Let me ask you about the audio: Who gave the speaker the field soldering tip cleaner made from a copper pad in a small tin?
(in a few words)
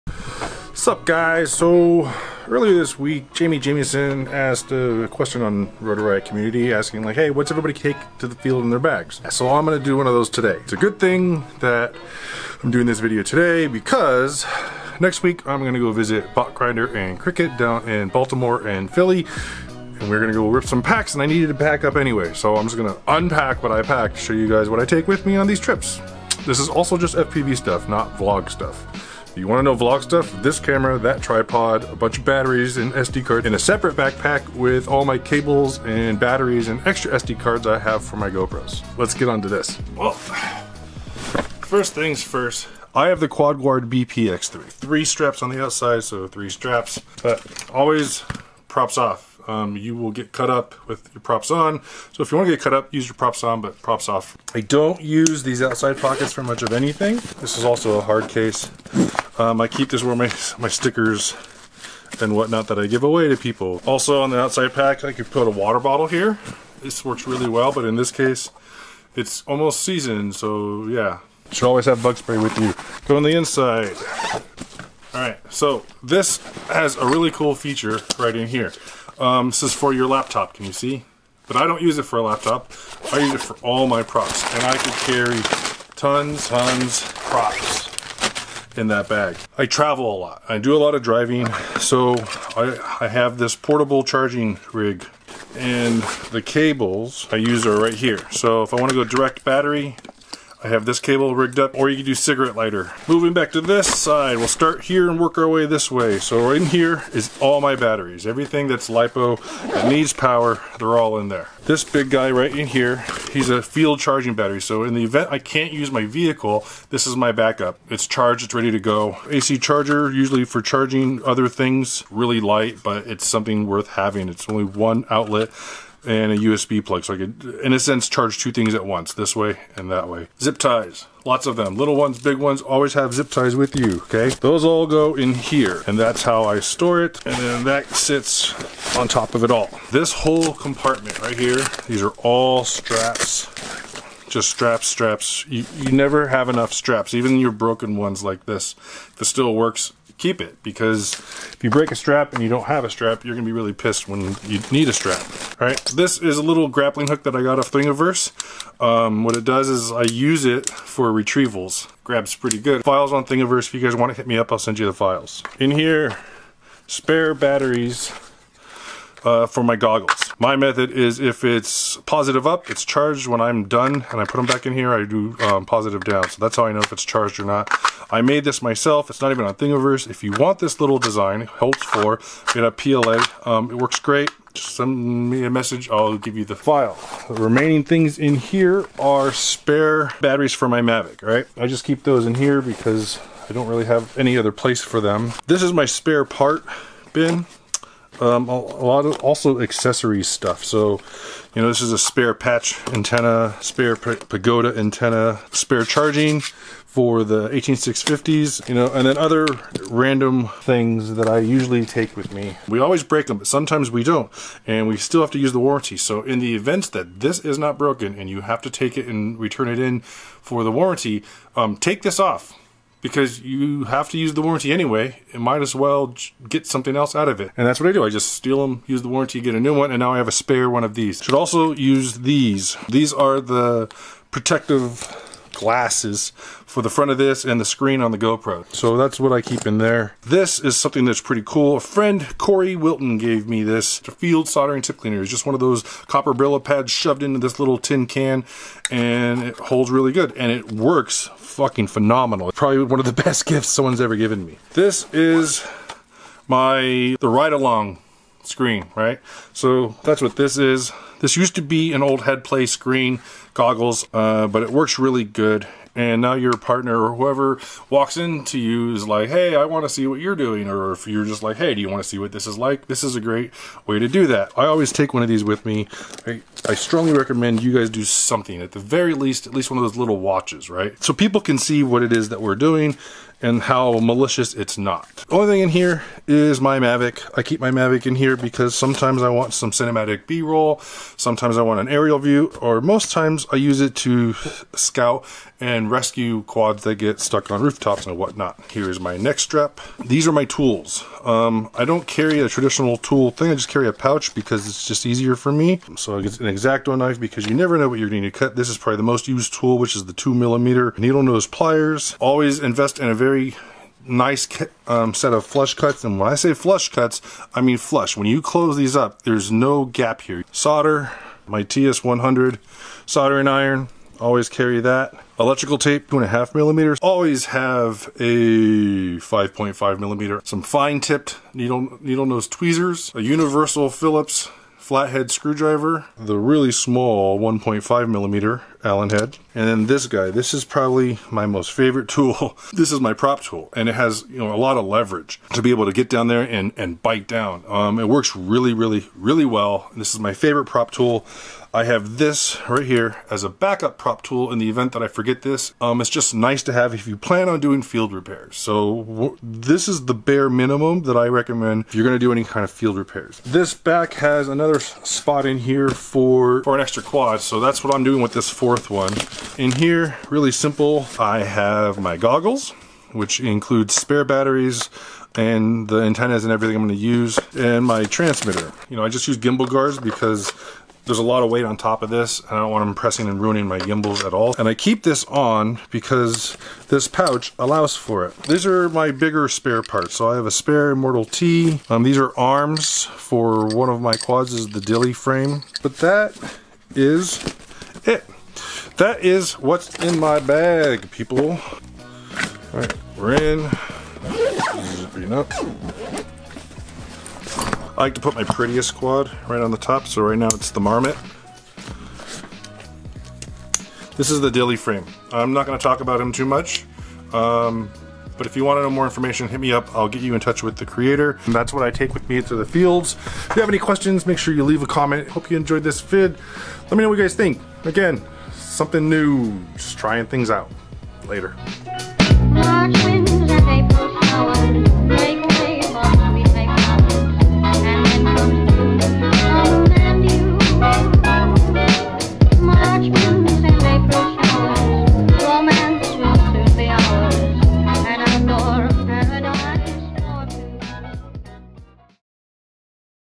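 Corey Wilton.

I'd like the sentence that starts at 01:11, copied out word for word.
You should always have bug spray with you.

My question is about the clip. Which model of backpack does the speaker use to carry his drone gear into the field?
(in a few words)
Quad Guard BPX3.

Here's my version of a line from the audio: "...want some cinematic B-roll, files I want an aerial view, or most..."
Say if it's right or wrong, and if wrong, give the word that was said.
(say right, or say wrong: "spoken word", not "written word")
wrong: "sometimes", not "files".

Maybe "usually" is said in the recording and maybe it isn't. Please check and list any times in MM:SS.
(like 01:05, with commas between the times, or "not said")
02:00, 03:31.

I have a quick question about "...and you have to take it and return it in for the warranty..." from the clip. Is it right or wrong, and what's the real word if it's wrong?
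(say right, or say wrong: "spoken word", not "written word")
right.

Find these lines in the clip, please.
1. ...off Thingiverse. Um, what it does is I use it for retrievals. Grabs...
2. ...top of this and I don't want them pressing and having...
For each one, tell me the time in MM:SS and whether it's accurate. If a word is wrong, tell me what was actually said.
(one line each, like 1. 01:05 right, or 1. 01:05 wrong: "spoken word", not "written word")
1. 02:37 right
2. 06:21 wrong: "ruining", not "having".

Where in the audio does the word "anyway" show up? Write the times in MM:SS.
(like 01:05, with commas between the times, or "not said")
00:21, 03:44.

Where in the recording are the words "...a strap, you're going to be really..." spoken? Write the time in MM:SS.
02:32.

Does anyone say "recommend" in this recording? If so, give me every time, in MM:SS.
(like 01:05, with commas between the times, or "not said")
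04:37, 06:01.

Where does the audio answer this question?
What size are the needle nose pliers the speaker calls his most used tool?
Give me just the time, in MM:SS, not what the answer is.
05:10.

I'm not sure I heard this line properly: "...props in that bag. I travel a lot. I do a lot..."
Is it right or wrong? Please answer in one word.
right.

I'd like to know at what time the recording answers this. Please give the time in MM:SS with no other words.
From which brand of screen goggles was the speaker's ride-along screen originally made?
04:22.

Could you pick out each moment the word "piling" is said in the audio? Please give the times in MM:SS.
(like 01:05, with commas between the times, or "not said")
not said.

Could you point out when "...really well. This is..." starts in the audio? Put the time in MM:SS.
05:49.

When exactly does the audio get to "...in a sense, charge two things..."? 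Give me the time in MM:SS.
02:07.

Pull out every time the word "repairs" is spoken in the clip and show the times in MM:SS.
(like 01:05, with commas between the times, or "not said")
05:58, 06:02.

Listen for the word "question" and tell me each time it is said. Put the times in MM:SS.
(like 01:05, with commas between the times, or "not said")
00:05, 07:03.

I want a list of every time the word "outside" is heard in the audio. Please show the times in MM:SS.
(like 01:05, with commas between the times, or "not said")
00:45, 00:55, 01:04.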